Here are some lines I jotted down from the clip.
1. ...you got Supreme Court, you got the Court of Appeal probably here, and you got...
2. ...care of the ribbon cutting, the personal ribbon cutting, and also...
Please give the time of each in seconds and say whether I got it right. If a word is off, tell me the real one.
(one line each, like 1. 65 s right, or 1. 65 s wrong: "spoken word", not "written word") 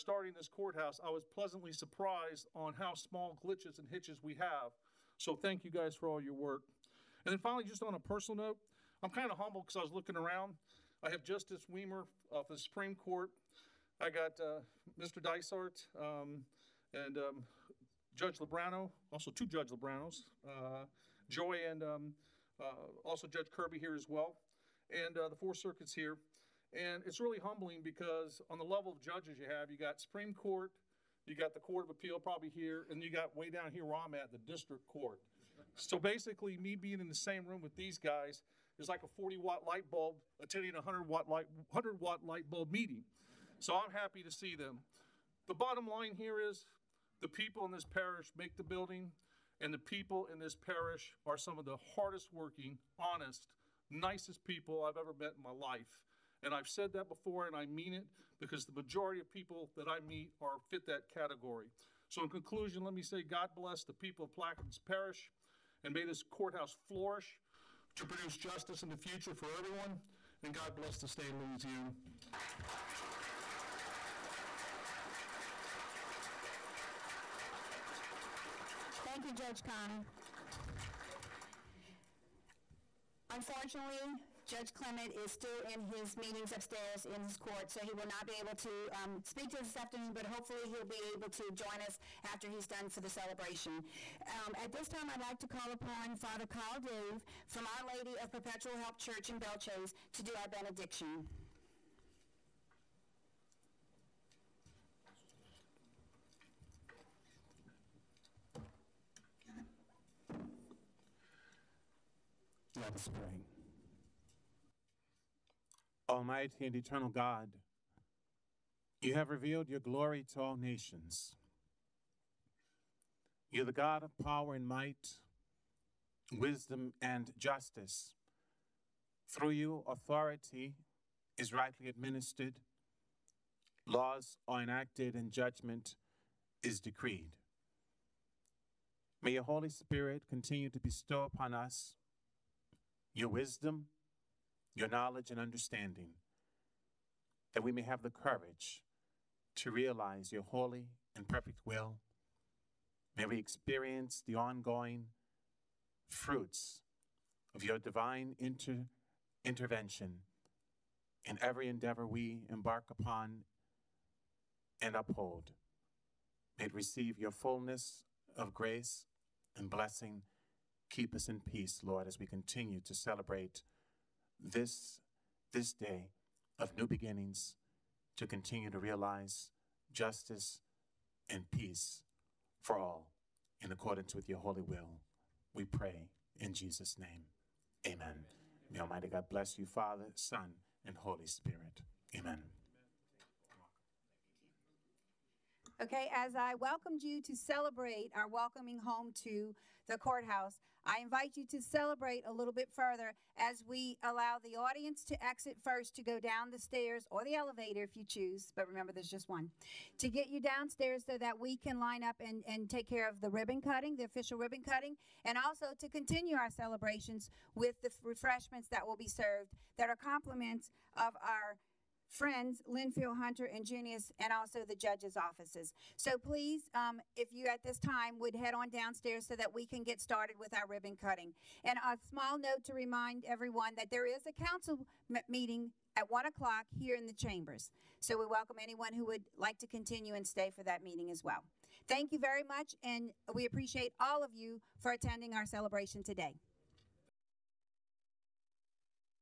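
1. 29 s right
2. 212 s wrong: "official", not "personal".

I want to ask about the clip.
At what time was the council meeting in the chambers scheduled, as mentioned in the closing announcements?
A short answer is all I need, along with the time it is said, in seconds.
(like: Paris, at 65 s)
1 o'clock, at 236 s.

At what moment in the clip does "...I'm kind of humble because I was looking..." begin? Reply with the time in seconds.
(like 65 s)
9 s.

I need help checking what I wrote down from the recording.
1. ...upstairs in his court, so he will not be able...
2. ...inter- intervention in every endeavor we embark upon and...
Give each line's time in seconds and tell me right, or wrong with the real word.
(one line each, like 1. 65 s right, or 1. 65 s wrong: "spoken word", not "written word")
1. 86 s right
2. 158 s right.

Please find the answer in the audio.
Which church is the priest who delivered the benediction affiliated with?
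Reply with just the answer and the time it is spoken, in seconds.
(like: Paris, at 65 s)
Our Lady of Perpetual Help, at 97 s.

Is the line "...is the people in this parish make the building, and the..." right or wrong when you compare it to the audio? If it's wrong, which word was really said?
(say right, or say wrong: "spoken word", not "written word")
right.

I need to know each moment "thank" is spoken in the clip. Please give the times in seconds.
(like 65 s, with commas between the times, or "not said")
5 s, 79 s, 241 s.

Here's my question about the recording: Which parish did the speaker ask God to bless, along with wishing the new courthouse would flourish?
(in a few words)
Plaquemines Parish.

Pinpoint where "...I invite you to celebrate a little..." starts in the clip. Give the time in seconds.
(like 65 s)
200 s.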